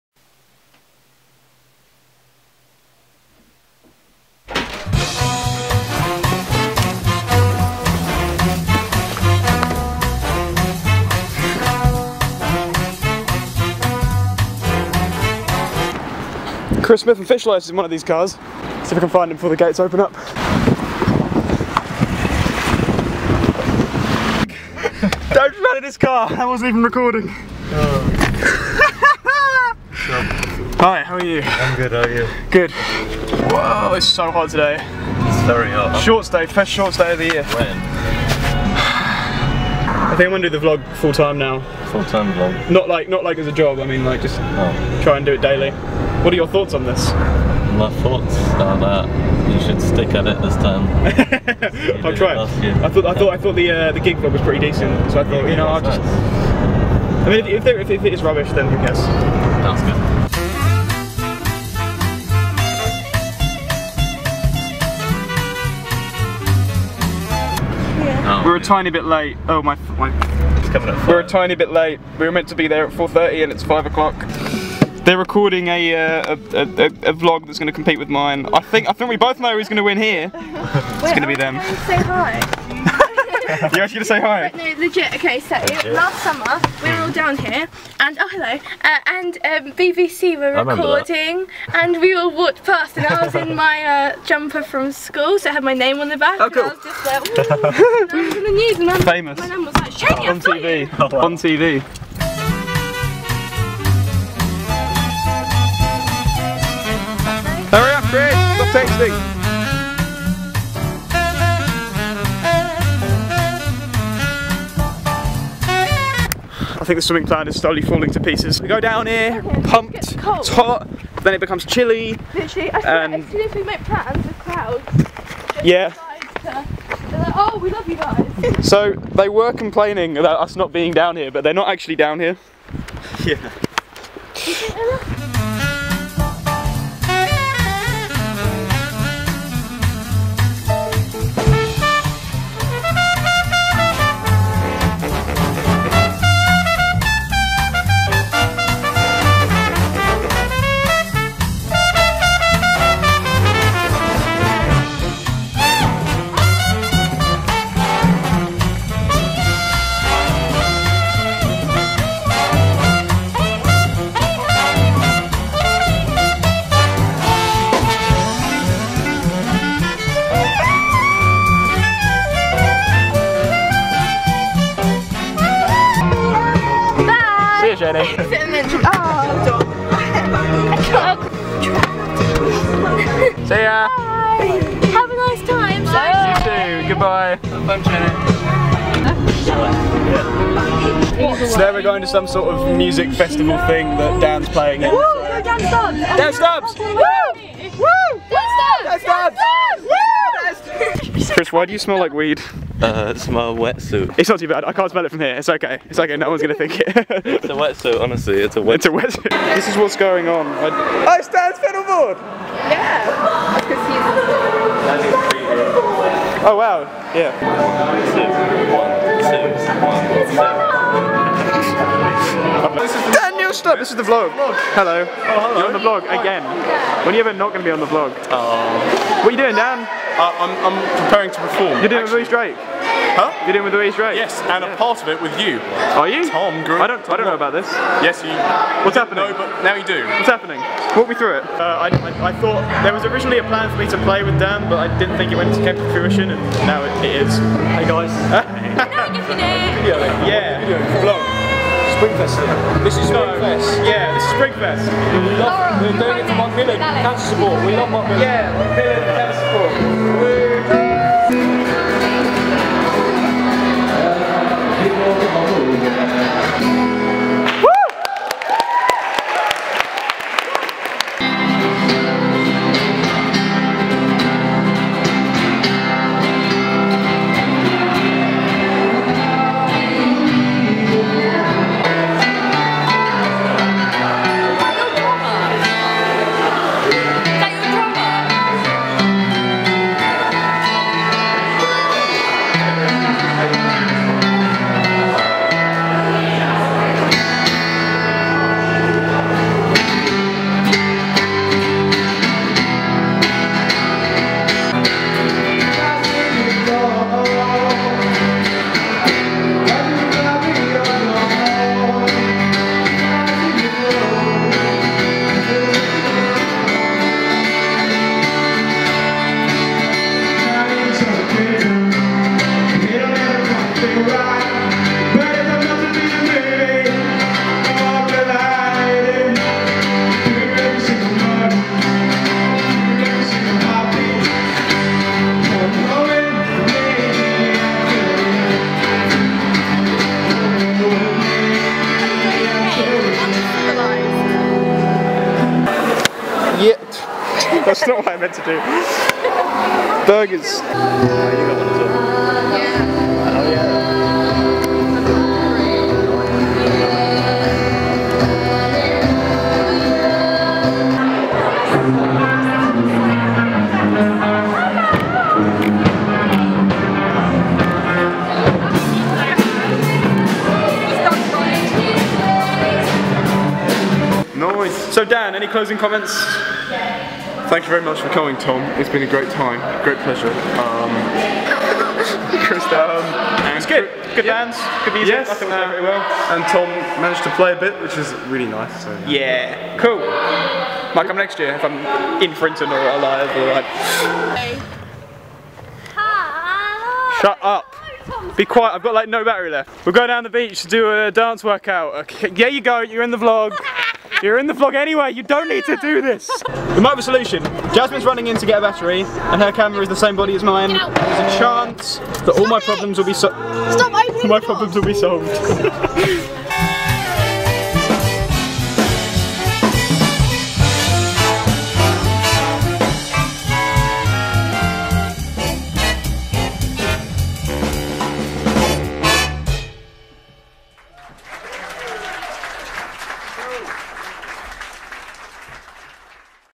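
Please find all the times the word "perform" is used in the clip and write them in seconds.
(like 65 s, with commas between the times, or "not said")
231 s.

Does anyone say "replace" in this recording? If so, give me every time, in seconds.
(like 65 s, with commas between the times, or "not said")
not said.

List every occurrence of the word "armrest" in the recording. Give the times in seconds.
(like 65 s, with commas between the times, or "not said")
not said.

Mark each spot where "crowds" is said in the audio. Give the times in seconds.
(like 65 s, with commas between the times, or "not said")
124 s.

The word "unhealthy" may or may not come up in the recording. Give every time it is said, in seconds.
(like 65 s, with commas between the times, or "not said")
not said.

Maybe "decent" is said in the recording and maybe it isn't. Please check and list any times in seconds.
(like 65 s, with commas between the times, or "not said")
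54 s.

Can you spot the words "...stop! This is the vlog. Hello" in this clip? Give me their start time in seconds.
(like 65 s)
223 s.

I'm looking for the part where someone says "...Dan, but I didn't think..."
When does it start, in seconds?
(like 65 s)
244 s.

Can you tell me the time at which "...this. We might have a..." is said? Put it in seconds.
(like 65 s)
405 s.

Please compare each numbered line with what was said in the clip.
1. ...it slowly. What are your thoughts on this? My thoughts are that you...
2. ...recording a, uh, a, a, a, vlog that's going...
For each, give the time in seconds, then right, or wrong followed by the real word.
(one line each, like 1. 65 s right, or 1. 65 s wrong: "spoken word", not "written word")
1. 45 s wrong: "daily", not "slowly"
2. 75 s right.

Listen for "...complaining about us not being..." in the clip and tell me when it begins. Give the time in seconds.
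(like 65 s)
129 s.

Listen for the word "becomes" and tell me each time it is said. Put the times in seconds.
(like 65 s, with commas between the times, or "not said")
121 s.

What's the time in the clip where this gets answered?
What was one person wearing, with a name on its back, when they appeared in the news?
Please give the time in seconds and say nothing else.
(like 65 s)
94 s.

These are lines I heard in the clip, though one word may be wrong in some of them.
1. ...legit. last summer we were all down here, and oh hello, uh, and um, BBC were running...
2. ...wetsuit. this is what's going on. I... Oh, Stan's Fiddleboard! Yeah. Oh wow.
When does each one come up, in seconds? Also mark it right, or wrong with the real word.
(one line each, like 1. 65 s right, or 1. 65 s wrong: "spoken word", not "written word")
1. 85 s wrong: "recording", not "running"
2. 208 s right.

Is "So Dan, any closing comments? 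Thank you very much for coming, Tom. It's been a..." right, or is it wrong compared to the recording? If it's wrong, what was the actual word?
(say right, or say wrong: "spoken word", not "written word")
right.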